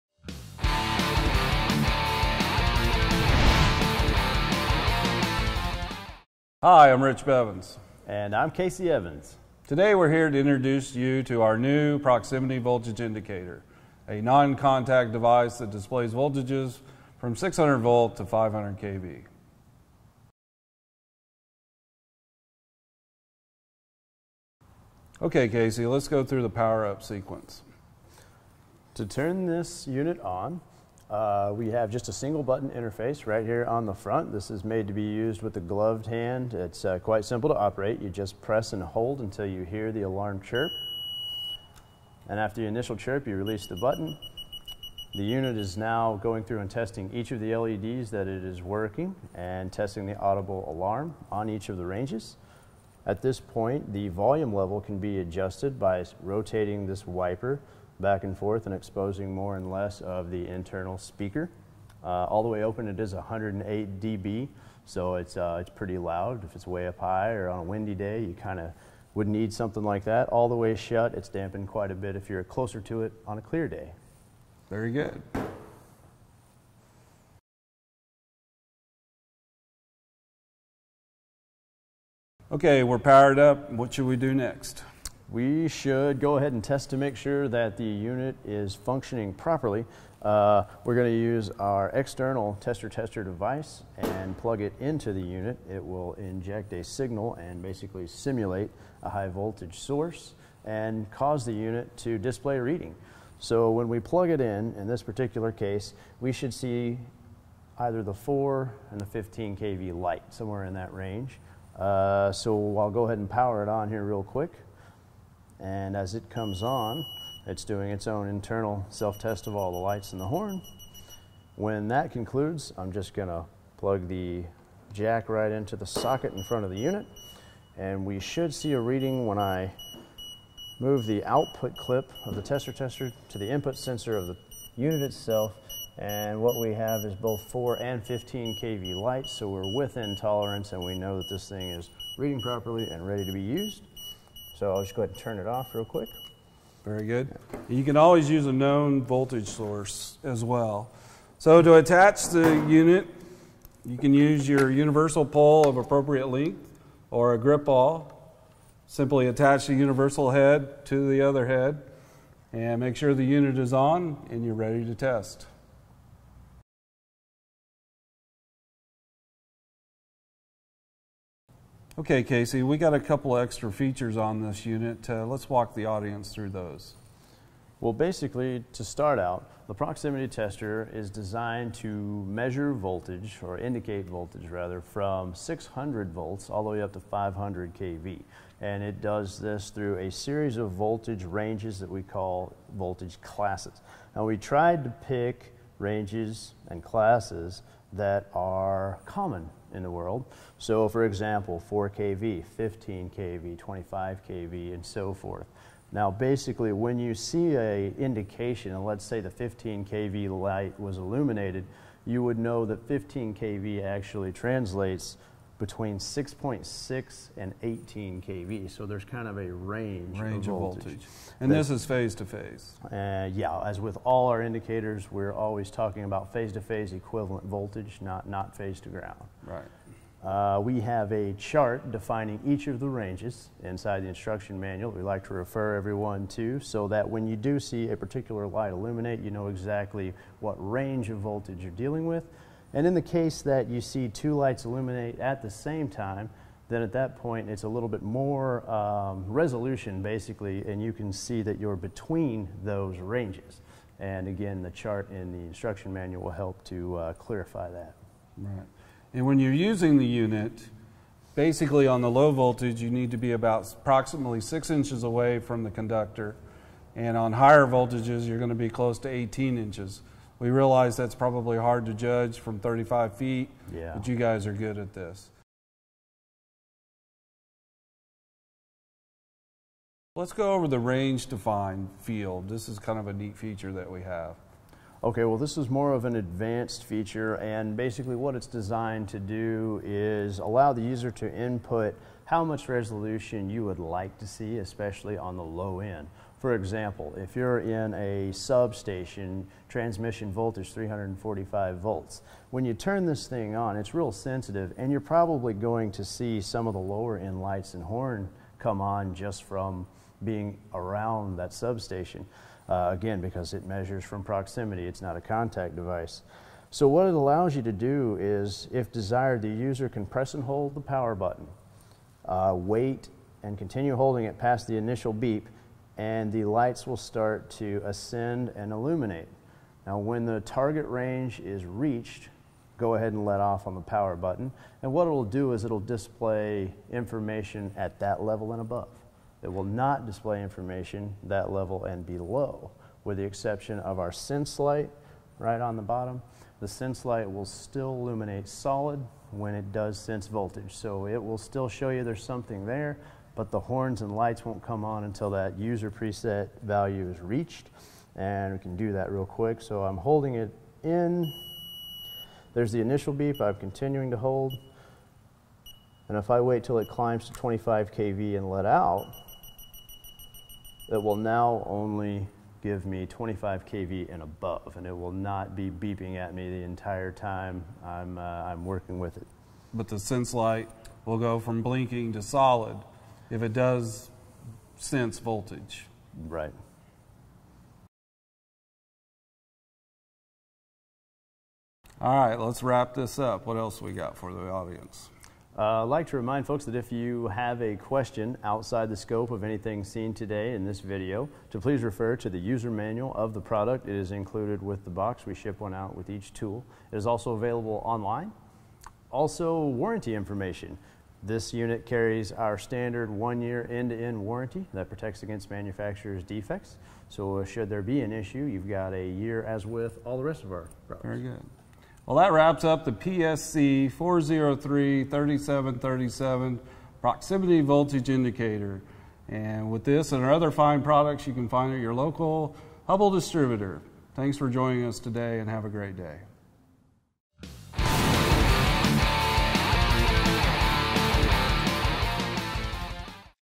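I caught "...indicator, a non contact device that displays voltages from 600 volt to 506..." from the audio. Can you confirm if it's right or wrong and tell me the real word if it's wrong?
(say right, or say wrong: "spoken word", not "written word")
wrong: "500", not "506".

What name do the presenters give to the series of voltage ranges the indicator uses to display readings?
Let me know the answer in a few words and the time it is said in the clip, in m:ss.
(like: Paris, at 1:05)
voltage classes, at 3:12.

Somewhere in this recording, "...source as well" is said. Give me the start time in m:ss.
2:29.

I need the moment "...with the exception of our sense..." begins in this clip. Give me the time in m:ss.
5:43.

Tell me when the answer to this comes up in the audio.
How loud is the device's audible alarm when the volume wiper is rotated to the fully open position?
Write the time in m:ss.
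1:03.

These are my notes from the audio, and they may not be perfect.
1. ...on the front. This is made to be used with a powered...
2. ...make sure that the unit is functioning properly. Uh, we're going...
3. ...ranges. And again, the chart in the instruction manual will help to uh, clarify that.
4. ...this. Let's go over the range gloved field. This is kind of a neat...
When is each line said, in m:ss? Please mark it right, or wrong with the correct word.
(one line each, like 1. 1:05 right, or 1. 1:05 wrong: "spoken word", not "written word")
1. 0:33 wrong: "gloved", not "powered"
2. 1:26 right
3. 4:12 right
4. 4:34 wrong: "defined", not "gloved".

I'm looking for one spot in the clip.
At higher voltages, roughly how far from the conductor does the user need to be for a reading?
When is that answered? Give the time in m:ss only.
4:29.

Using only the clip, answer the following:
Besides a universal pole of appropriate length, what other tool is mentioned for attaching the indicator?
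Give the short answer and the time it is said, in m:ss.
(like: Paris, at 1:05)
grip ball, at 2:37.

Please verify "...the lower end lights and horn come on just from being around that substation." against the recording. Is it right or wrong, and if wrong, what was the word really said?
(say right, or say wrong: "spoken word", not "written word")
right.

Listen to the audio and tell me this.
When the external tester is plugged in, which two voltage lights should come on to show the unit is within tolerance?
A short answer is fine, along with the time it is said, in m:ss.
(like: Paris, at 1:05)
4 and 15 kV, at 1:48.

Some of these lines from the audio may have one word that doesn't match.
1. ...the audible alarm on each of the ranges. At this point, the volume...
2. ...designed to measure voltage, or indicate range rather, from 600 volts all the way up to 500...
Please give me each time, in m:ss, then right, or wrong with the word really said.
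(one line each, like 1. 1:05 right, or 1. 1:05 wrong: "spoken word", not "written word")
1. 0:50 right
2. 3:01 wrong: "voltage", not "range".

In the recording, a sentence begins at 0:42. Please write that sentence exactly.
And after the initial chirp, you release the button.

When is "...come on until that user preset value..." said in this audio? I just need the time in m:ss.
5:54.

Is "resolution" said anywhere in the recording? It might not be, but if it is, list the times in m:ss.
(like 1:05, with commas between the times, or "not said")
4:09, 4:52.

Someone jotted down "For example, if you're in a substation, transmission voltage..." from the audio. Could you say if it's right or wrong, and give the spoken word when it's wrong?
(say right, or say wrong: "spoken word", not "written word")
right.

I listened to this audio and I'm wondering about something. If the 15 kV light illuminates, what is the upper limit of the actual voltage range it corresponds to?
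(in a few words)
18 kV.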